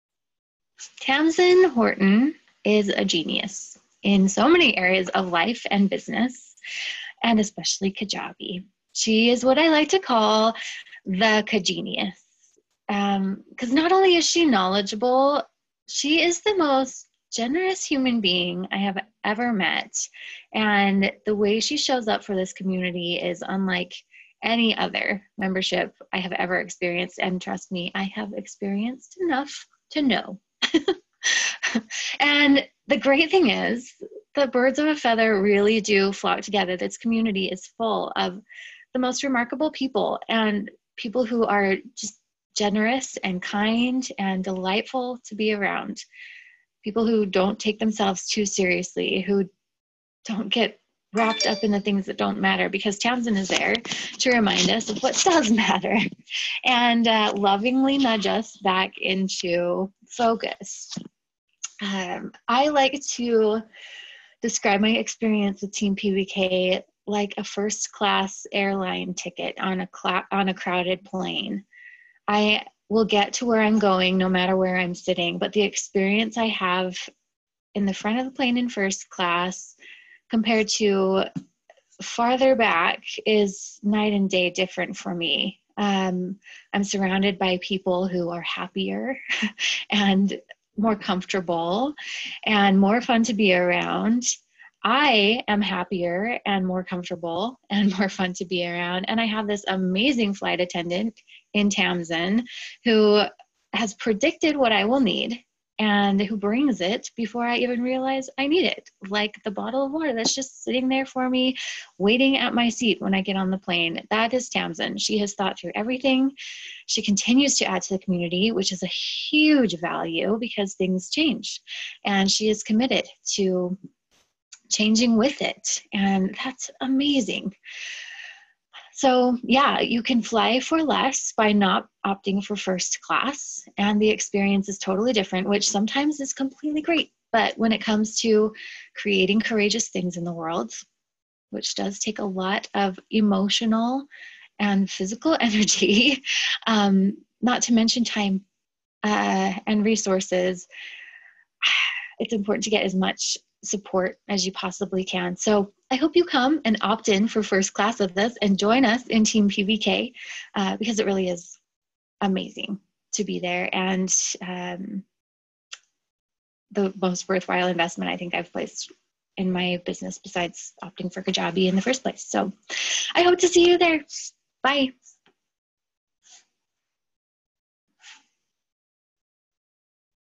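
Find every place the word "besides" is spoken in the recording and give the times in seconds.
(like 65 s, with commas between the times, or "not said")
170 s.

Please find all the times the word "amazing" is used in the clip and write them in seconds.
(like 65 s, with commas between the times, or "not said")
99 s, 126 s, 162 s.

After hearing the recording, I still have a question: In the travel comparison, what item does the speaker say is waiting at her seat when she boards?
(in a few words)
bottle of water.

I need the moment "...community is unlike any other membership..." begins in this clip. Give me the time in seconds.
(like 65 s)
22 s.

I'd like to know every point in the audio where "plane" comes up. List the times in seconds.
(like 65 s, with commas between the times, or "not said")
71 s, 78 s, 113 s.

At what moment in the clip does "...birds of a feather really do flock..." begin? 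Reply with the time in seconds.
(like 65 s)
34 s.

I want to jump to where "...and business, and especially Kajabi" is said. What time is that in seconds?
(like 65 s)
5 s.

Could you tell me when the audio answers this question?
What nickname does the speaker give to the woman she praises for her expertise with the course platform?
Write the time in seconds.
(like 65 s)
11 s.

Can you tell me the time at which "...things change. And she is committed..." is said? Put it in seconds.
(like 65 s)
120 s.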